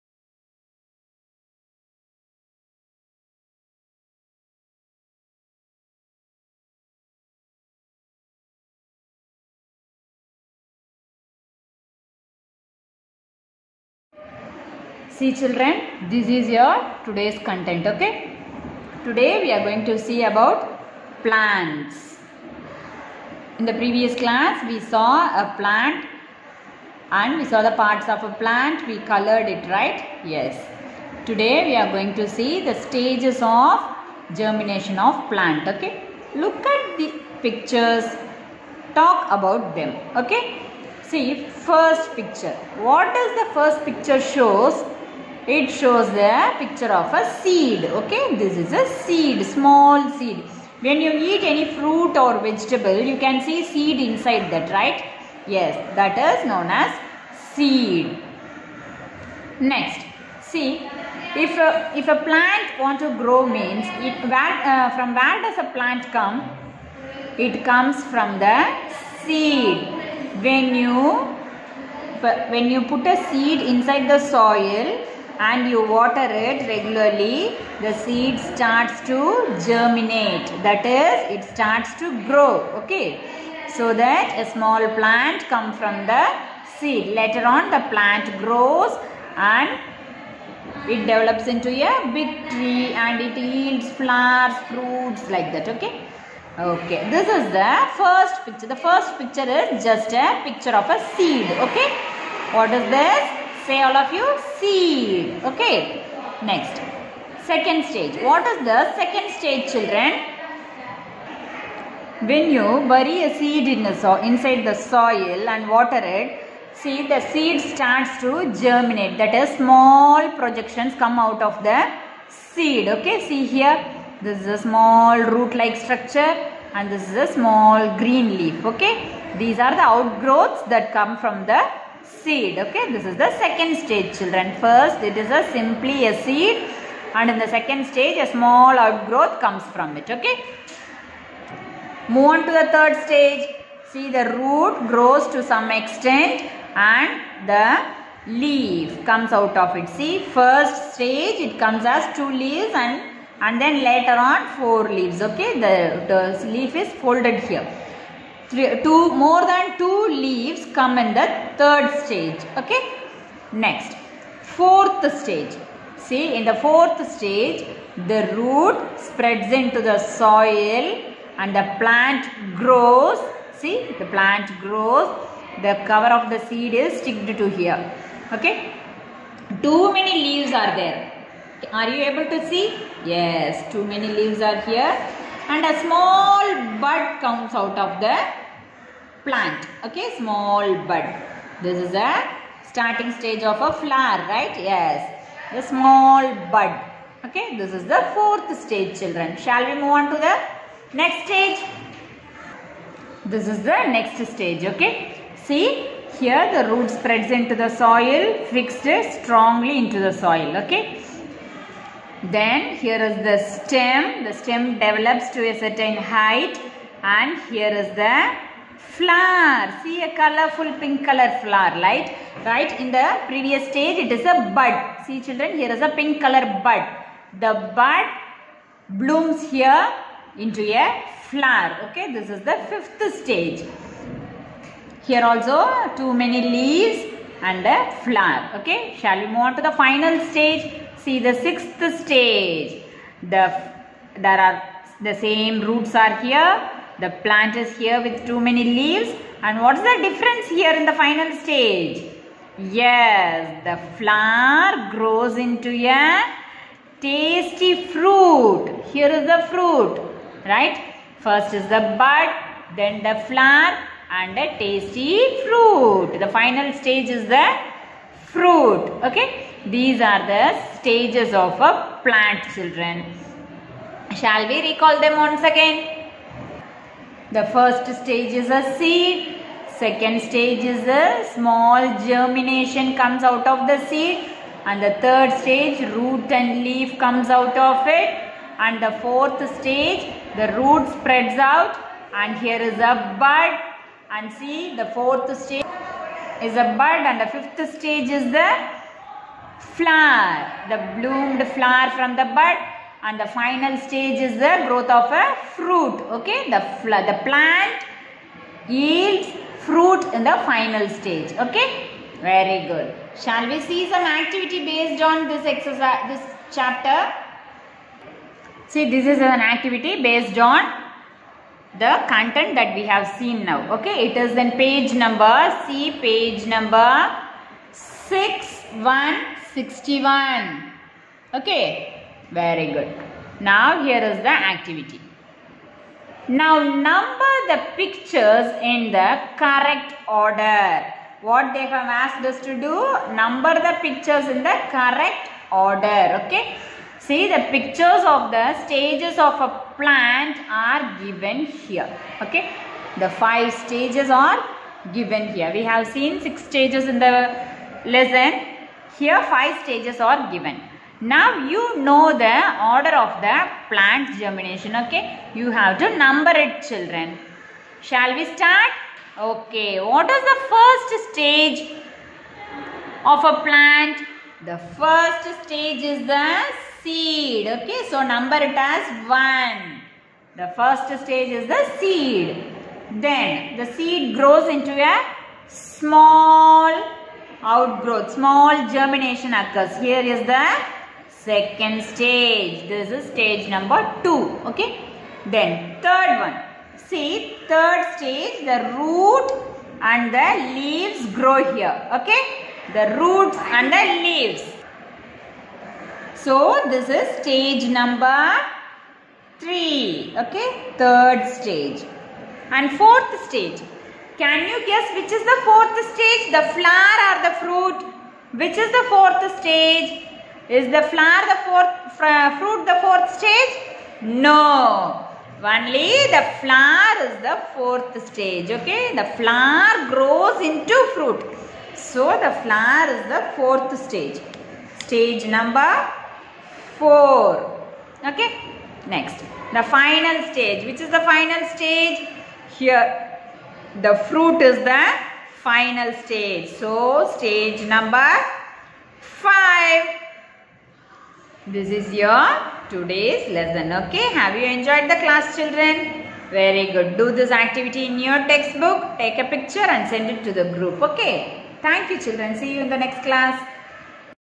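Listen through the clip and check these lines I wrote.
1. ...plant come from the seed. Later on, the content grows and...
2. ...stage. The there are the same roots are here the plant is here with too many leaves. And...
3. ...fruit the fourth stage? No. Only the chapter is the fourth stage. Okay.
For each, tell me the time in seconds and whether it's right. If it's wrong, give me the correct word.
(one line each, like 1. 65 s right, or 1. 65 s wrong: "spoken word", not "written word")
1. 84 s wrong: "plant", not "content"
2. 242 s right
3. 422 s wrong: "flower", not "chapter".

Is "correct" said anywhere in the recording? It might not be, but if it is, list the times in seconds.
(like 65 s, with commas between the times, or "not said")
339 s, 344 s.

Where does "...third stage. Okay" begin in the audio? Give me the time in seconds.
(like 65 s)
161 s.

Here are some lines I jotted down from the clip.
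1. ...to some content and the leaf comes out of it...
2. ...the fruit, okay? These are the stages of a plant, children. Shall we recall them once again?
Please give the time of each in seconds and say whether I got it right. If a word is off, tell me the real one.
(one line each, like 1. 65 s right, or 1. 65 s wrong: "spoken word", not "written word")
1. 145 s wrong: "extent", not "content"
2. 267 s right.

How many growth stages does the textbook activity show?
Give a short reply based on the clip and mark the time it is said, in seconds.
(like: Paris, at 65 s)
5, at 352 s.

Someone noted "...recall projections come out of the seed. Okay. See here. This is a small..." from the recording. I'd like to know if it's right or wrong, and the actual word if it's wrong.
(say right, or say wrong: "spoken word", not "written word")
wrong: "small", not "recall".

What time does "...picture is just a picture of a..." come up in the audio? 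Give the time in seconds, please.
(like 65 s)
99 s.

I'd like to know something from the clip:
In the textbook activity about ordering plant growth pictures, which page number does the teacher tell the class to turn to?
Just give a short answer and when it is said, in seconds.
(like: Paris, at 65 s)
61, at 326 s.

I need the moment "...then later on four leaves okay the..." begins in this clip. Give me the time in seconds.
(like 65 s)
153 s.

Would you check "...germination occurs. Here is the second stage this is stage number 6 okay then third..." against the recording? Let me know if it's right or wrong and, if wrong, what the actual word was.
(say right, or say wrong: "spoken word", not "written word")
wrong: "2", not "6".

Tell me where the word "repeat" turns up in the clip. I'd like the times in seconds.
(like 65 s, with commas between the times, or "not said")
not said.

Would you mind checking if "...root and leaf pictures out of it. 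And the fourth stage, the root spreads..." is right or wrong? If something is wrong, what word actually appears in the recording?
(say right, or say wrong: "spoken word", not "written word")
wrong: "comes", not "pictures".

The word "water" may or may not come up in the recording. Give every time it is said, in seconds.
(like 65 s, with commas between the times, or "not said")
75 s, 115 s.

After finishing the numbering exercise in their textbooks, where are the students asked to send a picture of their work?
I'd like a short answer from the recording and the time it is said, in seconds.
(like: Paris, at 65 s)
The group, at 459 s.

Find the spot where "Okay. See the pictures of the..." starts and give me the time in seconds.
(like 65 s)
346 s.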